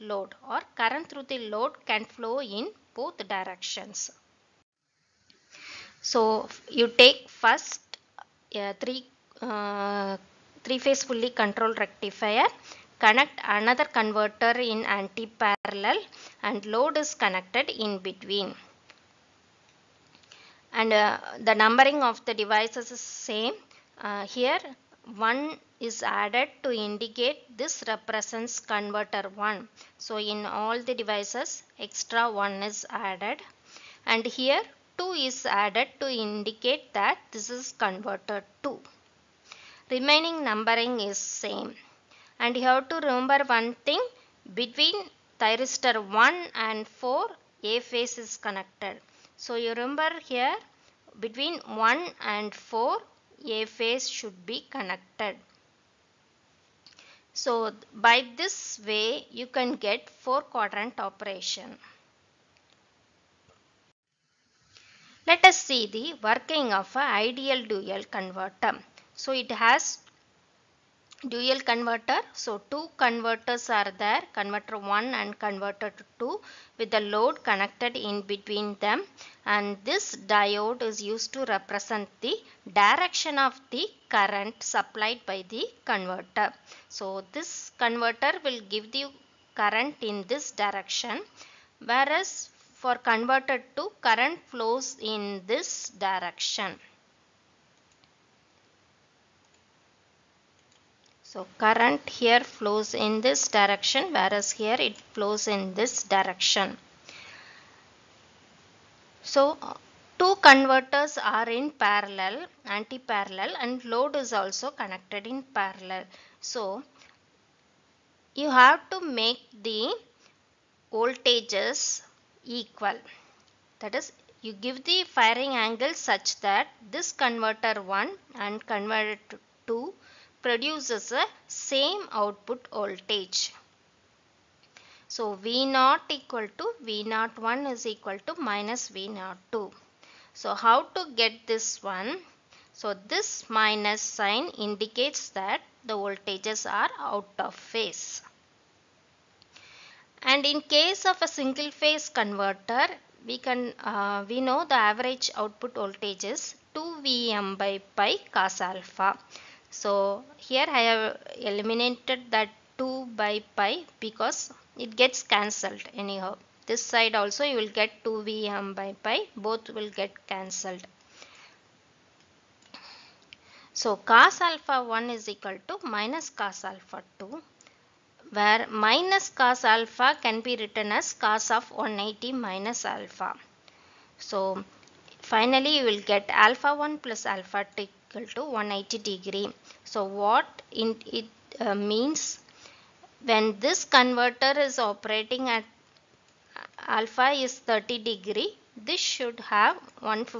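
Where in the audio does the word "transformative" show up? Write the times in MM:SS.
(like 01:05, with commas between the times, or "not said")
not said.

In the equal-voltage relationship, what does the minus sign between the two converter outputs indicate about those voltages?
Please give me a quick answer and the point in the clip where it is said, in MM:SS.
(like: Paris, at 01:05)
Out of phase, at 02:26.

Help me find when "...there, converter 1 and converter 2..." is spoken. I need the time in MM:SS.
01:14.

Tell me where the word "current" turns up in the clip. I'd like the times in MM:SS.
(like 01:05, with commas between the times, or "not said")
00:00, 01:24, 01:29, 01:34, 01:41.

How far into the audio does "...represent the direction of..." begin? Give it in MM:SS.
01:21.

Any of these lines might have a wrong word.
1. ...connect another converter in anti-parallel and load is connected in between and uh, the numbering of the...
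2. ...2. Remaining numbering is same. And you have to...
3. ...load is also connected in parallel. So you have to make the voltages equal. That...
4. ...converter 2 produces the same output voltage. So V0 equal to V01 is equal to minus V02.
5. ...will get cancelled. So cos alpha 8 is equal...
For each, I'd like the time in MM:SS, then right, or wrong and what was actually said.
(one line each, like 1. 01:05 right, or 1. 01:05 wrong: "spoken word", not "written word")
1. 00:13 right
2. 00:38 right
3. 01:53 right
4. 02:08 right
5. 02:49 wrong: "1", not "8".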